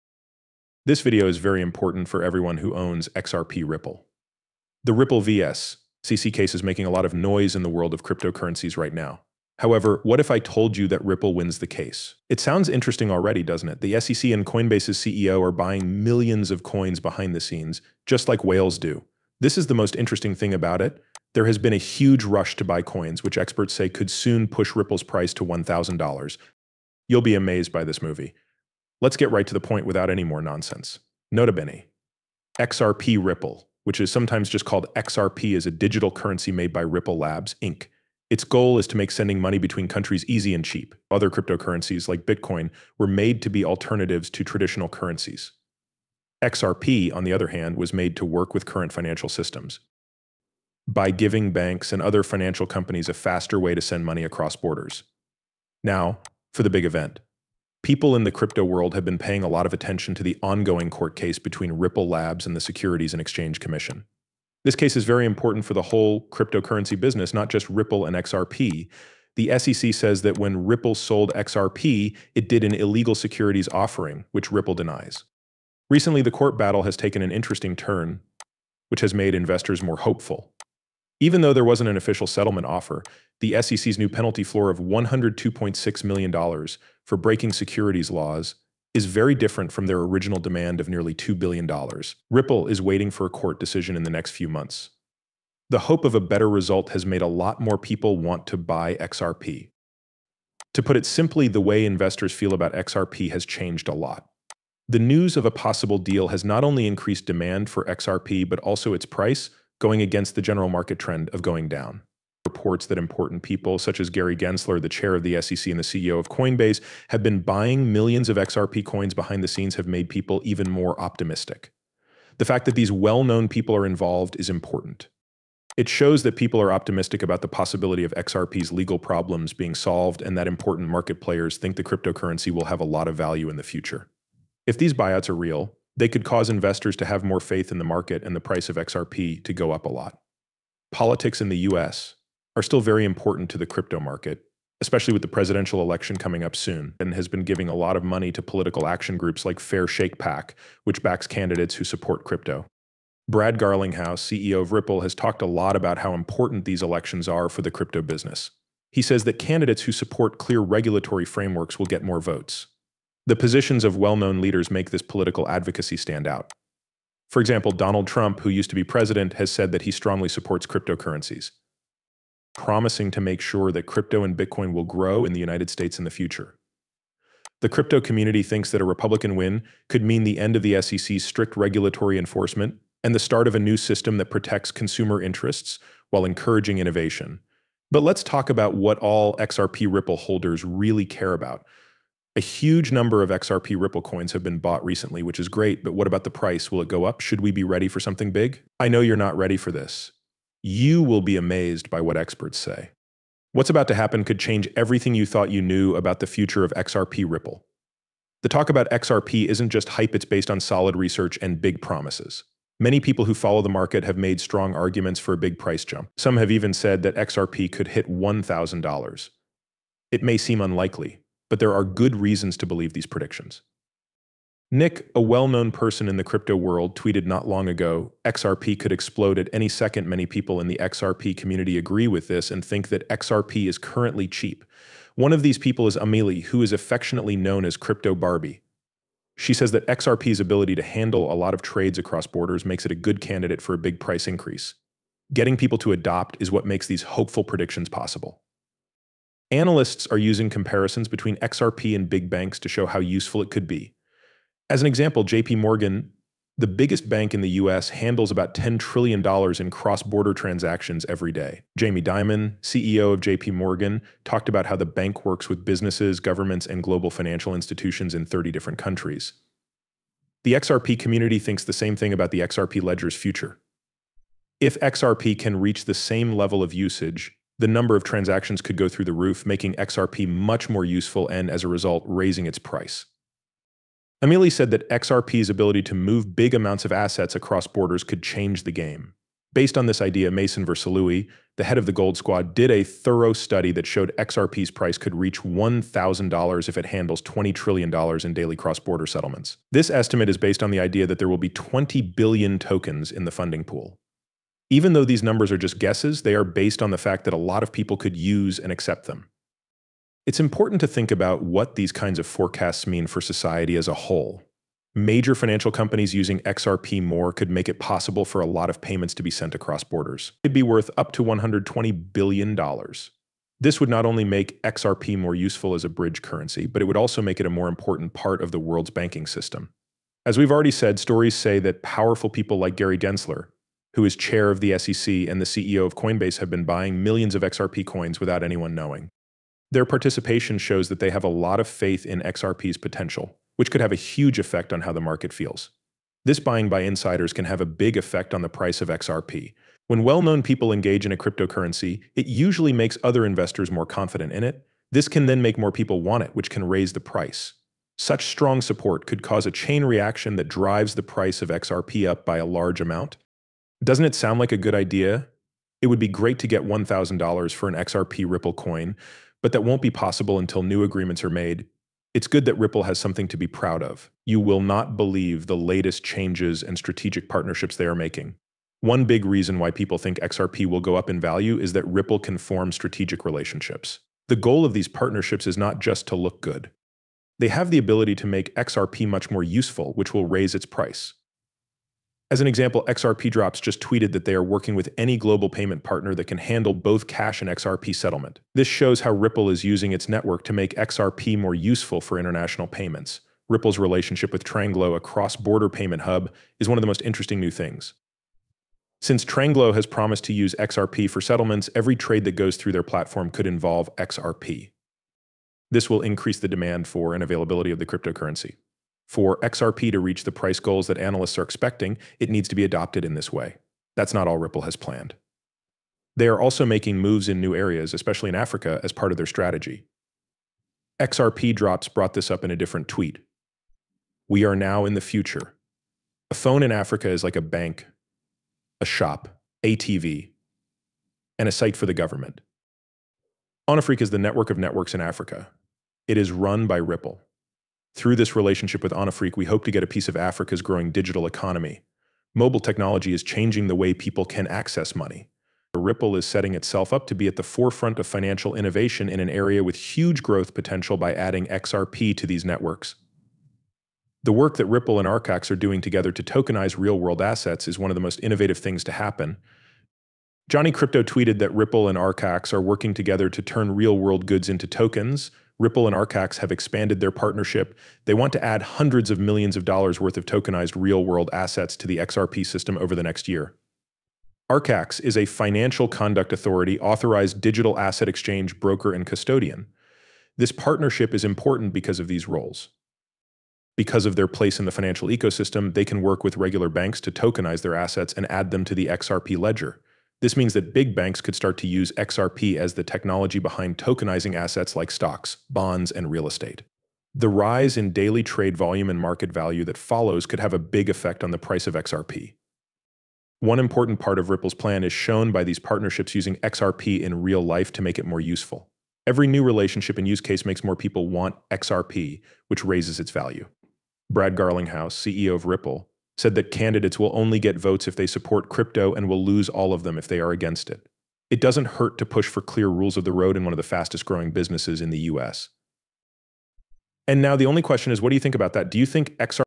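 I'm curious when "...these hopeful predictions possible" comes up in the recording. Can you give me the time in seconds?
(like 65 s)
246 s.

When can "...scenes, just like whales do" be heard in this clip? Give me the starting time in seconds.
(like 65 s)
17 s.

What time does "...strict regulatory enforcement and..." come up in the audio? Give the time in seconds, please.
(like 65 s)
181 s.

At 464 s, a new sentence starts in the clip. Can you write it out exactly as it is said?
The work that Ripple and Archax are doing together to tokenize real-world assets is one of the most innovative things to happen.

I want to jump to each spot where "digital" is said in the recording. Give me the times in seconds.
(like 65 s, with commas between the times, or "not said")
35 s, 450 s, 487 s.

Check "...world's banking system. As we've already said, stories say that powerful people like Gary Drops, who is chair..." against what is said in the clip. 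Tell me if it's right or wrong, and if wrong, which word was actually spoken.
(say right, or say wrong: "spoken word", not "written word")
wrong: "Gensler", not "Drops".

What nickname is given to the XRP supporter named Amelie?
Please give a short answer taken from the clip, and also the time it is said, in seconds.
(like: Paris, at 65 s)
Crypto Barbie, at 237 s.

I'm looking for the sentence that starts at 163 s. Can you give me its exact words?
The positions of well known leaders make this political advocacy stand out.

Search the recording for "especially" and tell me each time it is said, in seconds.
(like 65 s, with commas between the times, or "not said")
144 s, 427 s.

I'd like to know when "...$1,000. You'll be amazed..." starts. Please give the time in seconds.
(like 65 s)
25 s.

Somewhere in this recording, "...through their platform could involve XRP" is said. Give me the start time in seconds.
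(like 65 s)
412 s.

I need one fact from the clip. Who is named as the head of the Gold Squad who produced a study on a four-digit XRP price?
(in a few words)
Mason Versluis.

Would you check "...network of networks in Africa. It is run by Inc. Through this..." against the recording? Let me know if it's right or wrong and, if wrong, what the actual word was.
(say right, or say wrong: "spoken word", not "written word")
wrong: "Ripple", not "Inc".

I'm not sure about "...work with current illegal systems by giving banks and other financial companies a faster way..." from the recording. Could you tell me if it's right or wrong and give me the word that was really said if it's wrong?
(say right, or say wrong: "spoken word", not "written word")
wrong: "financial", not "illegal".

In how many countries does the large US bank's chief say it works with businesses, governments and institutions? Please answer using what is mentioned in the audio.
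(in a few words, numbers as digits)
30.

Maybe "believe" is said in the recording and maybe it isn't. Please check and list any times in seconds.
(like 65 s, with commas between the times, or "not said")
222 s, 374 s.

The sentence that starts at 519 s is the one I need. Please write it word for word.
Every new relationship and use case makes more people want XRP, which raises its value.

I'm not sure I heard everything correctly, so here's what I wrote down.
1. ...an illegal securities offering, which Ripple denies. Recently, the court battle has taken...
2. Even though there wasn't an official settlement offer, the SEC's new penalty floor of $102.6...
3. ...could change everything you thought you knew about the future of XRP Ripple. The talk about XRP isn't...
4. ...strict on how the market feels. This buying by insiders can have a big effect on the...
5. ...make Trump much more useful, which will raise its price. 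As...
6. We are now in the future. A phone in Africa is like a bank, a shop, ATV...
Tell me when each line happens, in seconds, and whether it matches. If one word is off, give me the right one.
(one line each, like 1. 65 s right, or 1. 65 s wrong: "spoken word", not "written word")
1. 72 s right
2. 81 s right
3. 204 s right
4. 344 s wrong: "effect", not "strict"
5. 388 s wrong: "XRP", not "Trump"
6. 434 s right.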